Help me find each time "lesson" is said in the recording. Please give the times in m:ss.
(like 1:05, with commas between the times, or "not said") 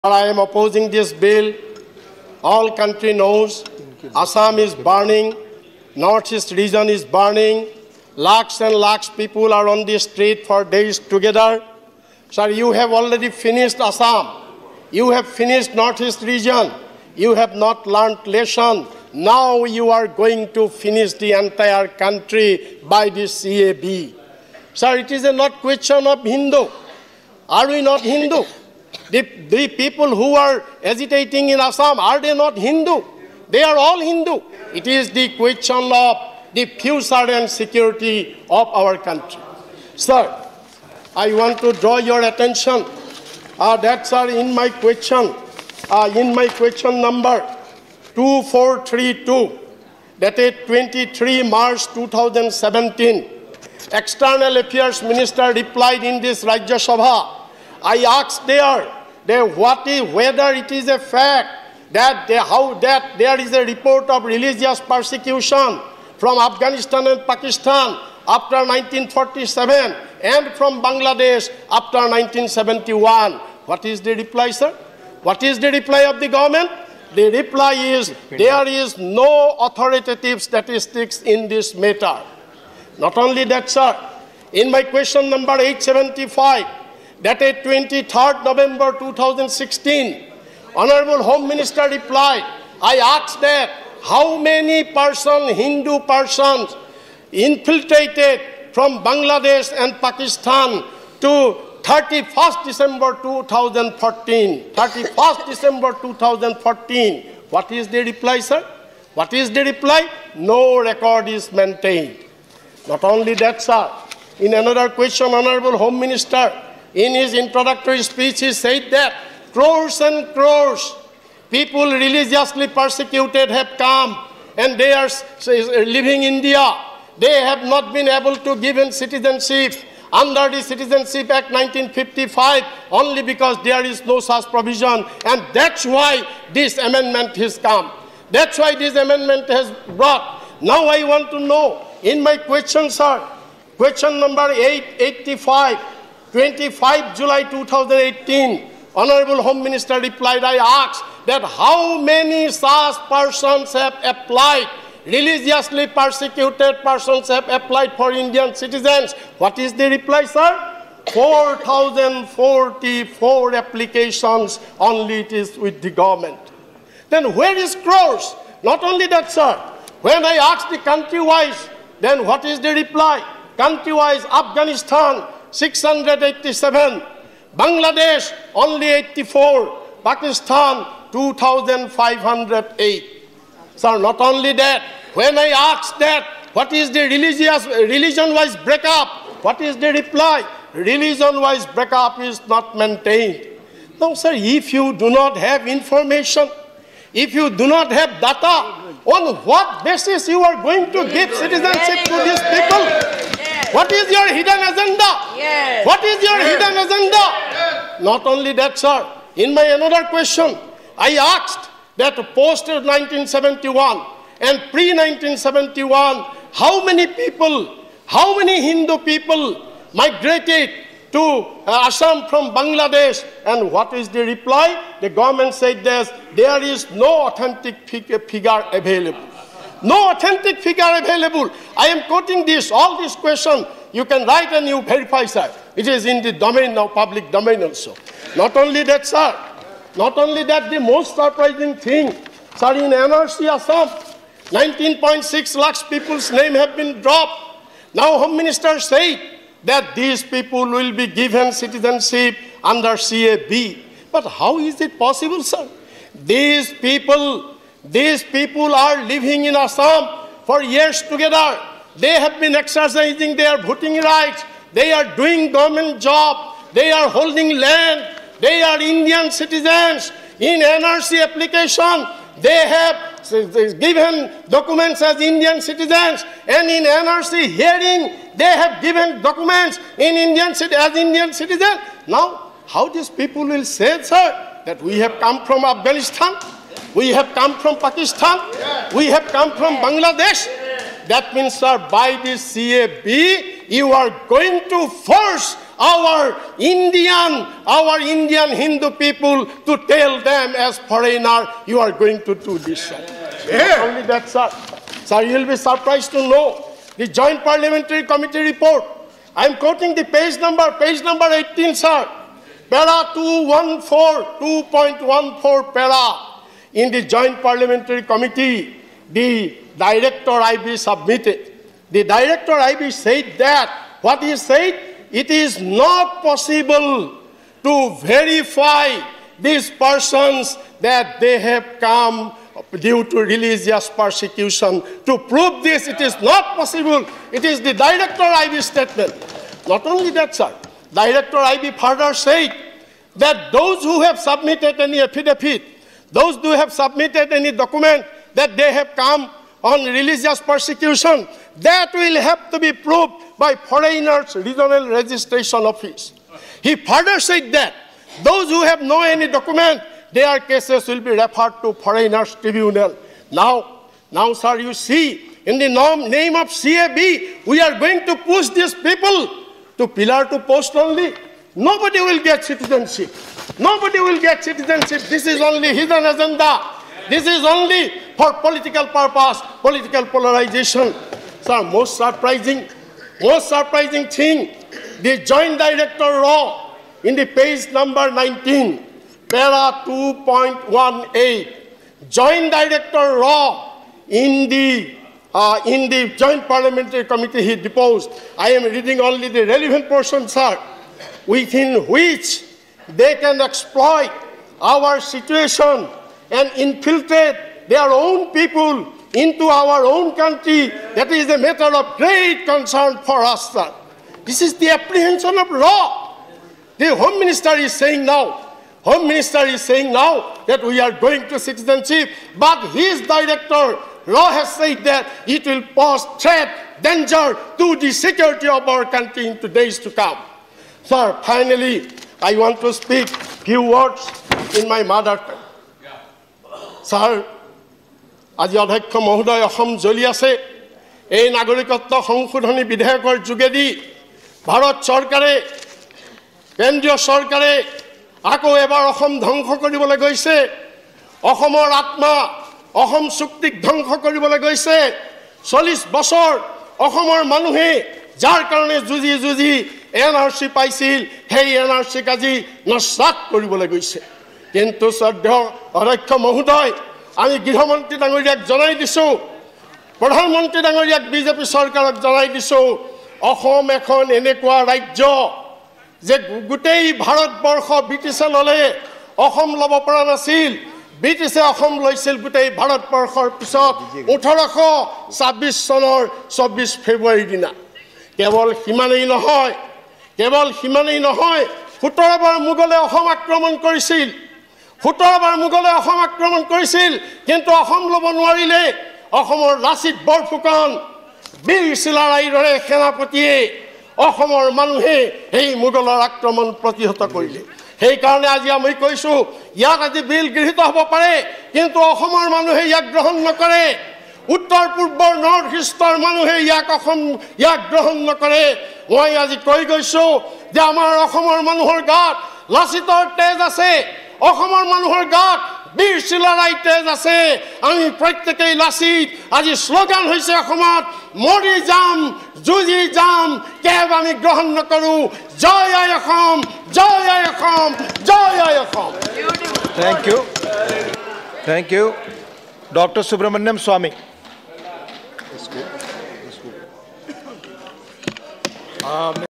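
0:18.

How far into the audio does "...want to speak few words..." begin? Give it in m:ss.
7:12.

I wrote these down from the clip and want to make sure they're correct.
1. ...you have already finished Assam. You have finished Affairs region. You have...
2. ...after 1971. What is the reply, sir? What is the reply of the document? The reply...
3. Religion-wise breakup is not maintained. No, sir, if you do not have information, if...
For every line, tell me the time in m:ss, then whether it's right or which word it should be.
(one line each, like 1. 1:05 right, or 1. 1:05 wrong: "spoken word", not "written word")
1. 0:12 wrong: "Northeast", not "Affairs"
2. 1:11 wrong: "government", not "document"
3. 3:10 right.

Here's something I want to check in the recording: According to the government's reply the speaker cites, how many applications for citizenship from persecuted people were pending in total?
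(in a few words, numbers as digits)
4,044.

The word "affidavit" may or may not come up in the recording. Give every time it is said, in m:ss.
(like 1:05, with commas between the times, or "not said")
5:45.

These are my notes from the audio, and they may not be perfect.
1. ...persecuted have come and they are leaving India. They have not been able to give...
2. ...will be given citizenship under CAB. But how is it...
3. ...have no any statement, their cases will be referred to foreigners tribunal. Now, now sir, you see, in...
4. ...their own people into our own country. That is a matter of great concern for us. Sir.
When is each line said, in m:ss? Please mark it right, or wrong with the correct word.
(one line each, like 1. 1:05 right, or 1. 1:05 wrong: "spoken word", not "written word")
1. 2:02 right
2. 4:10 right
3. 5:58 wrong: "document", not "statement"
4. 6:47 right.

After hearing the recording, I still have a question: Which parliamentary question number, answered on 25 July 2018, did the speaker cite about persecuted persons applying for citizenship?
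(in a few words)
885.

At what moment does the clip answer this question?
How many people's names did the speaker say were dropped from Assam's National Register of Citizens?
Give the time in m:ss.
4:04.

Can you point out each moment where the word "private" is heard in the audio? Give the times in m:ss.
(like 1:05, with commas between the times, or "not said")
not said.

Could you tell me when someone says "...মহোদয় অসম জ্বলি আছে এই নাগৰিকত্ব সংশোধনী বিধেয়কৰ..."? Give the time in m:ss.
7:19.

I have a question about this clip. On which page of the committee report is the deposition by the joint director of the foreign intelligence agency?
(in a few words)
19.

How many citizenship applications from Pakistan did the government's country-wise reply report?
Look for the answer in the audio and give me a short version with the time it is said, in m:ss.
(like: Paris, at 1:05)
2,508, at 3:01.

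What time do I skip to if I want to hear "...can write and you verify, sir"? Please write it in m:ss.
3:54.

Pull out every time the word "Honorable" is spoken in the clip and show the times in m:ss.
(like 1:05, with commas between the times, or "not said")
1:30, 1:55, 2:28.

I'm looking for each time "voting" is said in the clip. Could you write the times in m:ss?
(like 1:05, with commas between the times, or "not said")
4:23.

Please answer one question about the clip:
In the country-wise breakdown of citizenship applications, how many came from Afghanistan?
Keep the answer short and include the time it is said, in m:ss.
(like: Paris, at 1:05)
687, at 2:55.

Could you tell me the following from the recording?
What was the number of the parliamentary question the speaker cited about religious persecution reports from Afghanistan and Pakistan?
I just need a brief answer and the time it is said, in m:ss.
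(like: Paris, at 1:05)
2432, at 0:48.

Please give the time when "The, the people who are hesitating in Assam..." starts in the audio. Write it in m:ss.
0:29.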